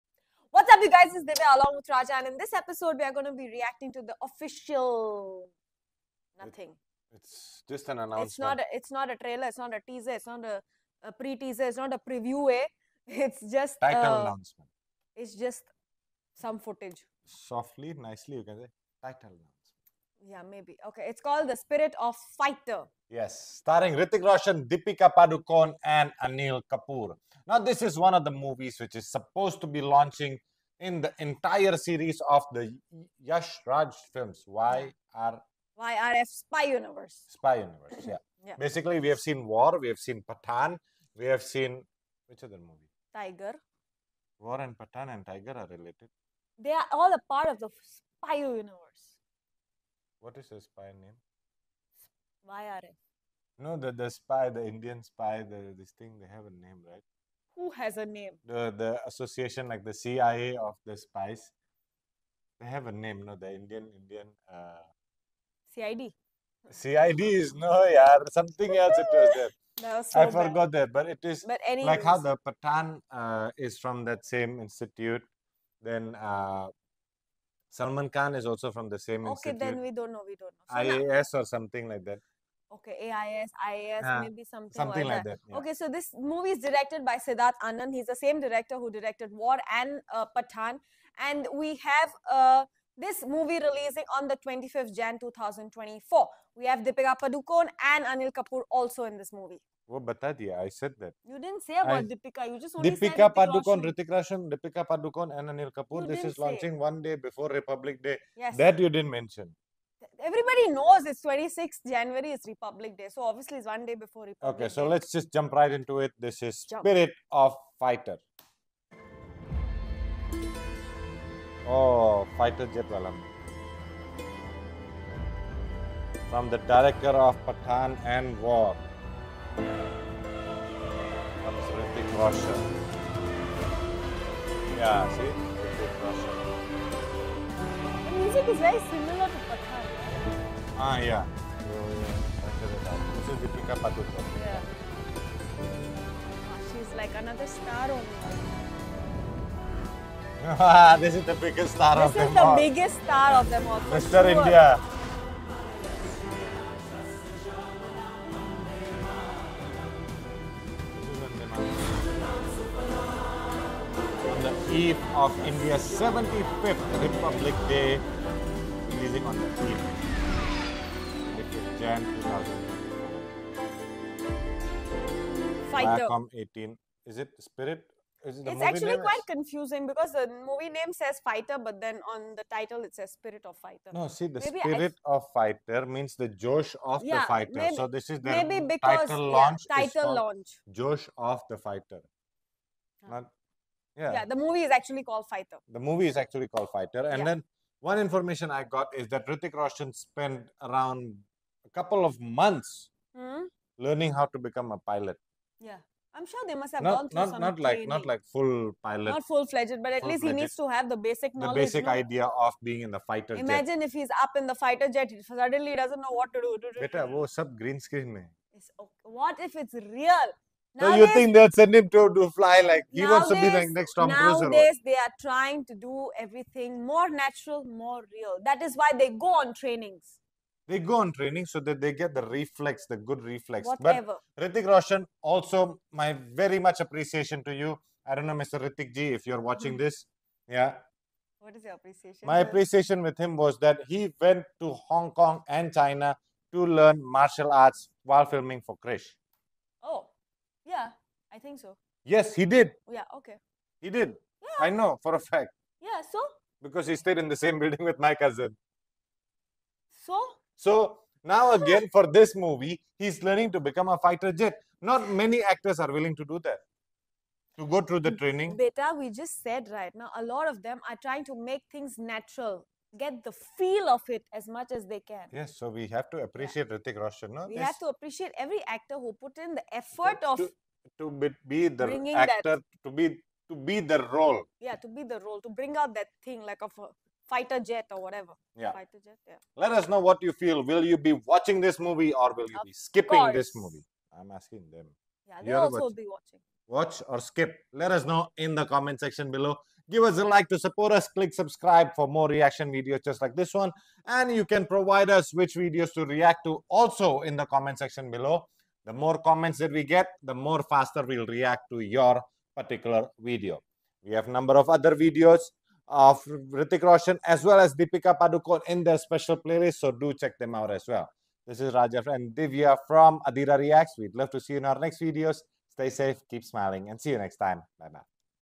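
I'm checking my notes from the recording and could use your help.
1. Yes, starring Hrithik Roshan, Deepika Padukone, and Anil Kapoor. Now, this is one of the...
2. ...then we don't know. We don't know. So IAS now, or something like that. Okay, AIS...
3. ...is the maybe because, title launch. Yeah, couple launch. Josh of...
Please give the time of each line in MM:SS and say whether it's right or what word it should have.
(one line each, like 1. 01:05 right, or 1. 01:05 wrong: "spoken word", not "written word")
1. 00:23 right
2. 01:19 right
3. 03:08 wrong: "title", not "couple".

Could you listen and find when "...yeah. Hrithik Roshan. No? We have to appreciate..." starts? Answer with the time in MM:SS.
04:36.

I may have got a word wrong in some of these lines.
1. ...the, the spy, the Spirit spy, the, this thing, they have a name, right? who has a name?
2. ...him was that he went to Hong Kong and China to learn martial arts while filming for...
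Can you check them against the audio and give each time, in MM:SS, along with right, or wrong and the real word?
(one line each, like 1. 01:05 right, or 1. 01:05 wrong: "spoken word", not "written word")
1. 00:53 wrong: "Indian", not "Spirit"
2. 04:03 right.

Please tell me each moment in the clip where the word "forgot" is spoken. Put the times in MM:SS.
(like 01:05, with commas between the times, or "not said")
01:10.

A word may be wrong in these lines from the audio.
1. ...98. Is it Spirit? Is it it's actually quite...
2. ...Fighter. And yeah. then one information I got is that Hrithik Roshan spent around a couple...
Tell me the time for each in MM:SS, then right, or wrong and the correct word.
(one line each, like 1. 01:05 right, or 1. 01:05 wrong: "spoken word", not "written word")
1. 02:56 wrong: "18", not "98"
2. 03:16 right.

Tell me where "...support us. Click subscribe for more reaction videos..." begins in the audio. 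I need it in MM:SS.
05:00.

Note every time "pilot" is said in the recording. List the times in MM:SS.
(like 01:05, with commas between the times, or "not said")
03:24, 03:28.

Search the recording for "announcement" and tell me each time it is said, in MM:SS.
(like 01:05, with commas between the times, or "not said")
00:07, 00:14, 00:19.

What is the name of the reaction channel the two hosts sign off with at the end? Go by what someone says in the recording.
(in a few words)
Adira Reacts.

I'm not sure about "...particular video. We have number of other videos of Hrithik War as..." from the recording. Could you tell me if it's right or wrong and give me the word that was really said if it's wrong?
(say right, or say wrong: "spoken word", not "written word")
wrong: "Roshan", not "War".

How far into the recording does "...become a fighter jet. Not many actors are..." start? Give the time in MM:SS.
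04:23.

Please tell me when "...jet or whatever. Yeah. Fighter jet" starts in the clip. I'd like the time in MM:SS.
04:47.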